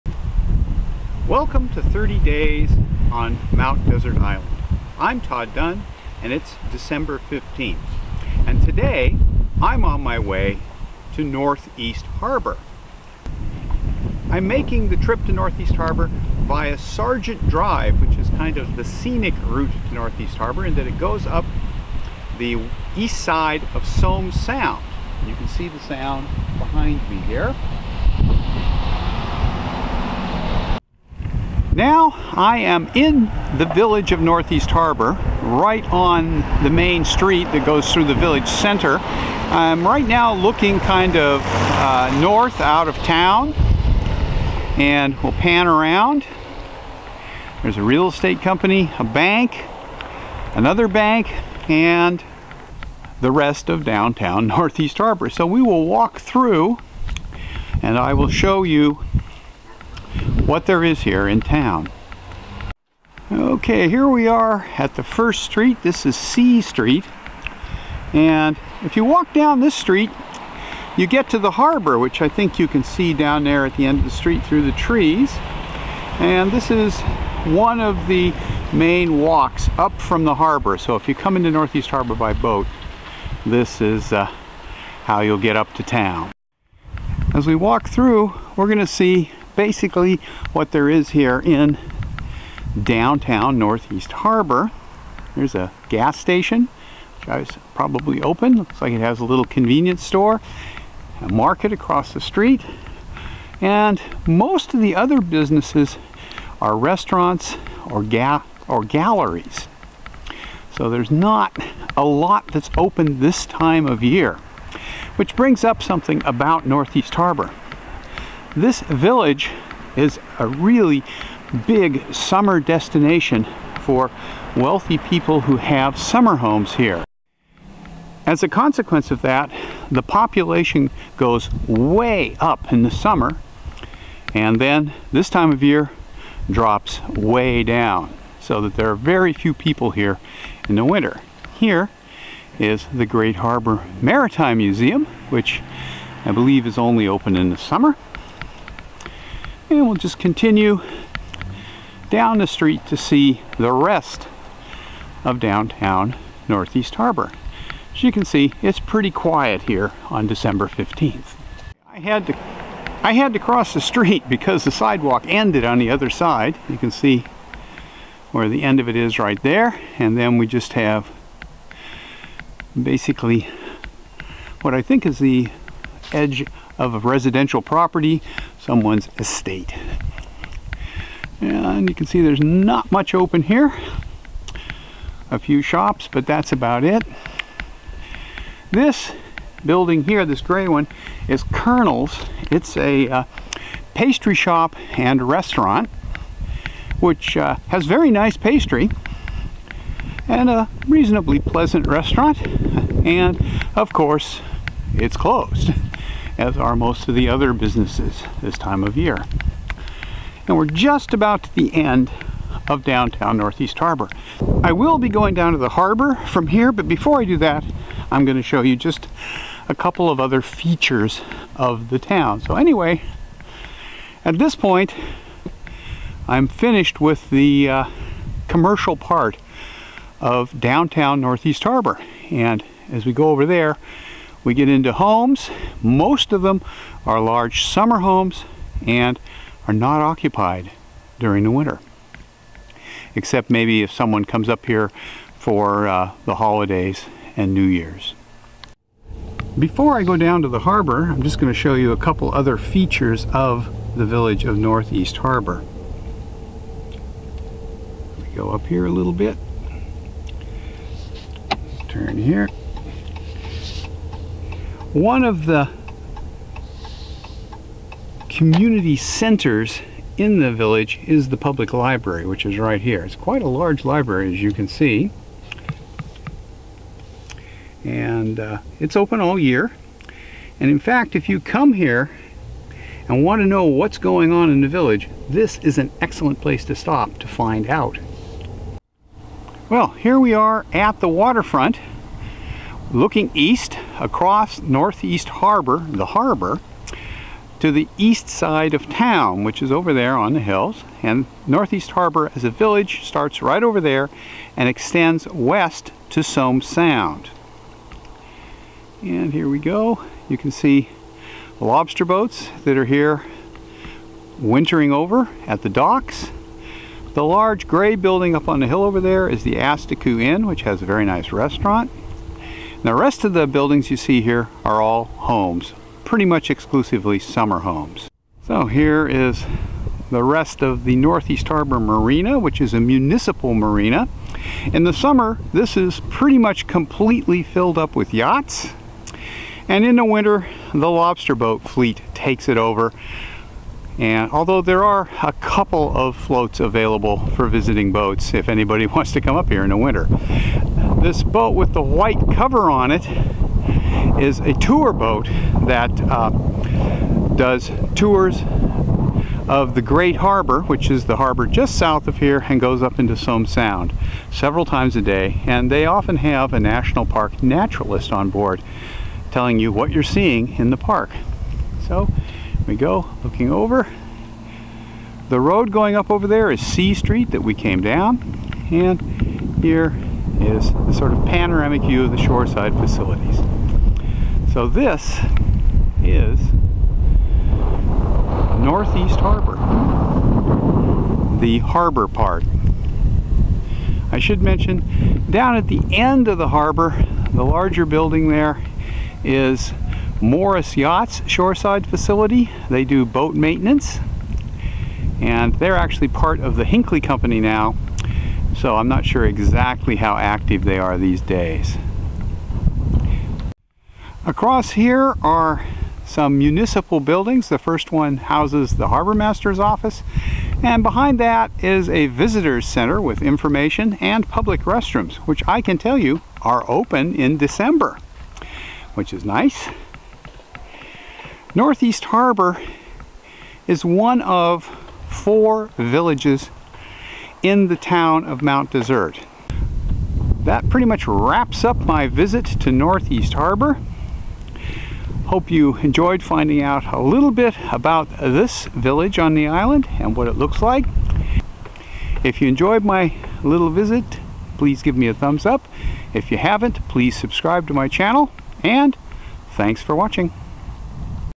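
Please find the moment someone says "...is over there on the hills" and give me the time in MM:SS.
04:59.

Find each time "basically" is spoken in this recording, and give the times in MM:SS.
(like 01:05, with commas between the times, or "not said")
01:29, 02:52.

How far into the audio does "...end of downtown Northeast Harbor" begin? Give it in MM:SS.
03:31.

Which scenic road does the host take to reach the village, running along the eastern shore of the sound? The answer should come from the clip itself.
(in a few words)
Sargent Drive.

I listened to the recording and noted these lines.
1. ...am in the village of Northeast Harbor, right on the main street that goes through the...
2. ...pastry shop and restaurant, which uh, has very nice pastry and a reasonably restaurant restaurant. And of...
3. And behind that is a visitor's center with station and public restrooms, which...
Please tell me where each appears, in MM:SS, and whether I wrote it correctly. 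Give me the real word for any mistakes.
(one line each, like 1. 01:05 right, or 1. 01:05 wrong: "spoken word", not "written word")
1. 00:32 right
2. 03:13 wrong: "pleasant", not "restaurant"
3. 07:00 wrong: "information", not "station".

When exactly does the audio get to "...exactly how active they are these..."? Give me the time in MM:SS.
06:49.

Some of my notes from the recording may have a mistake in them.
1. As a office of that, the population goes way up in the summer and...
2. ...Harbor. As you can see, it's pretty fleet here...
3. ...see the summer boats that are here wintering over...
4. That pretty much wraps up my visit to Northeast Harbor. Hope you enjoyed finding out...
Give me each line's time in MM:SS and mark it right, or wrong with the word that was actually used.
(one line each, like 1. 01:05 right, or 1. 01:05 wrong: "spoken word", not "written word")
1. 02:08 wrong: "consequence", not "office"
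2. 02:36 wrong: "quiet", not "fleet"
3. 05:10 wrong: "lobster", not "summer"
4. 07:20 right.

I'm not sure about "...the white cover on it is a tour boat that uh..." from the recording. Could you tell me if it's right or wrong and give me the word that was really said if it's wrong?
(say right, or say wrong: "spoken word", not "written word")
right.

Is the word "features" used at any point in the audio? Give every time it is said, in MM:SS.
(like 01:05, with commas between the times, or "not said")
03:40, 04:12.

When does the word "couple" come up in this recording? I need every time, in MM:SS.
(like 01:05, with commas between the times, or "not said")
03:39, 04:11, 05:45.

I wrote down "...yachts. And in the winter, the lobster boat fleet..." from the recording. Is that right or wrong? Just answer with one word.
right.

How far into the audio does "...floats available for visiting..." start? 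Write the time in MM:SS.
05:46.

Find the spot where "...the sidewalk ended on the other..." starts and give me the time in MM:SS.
02:44.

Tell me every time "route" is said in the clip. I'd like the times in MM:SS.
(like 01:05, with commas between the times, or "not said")
00:19.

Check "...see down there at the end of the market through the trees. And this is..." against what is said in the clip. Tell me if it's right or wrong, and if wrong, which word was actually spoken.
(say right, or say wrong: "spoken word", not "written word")
wrong: "street", not "market".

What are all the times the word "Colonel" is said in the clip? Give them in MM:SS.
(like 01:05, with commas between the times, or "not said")
03:11.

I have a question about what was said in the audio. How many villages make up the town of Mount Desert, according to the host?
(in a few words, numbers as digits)
4.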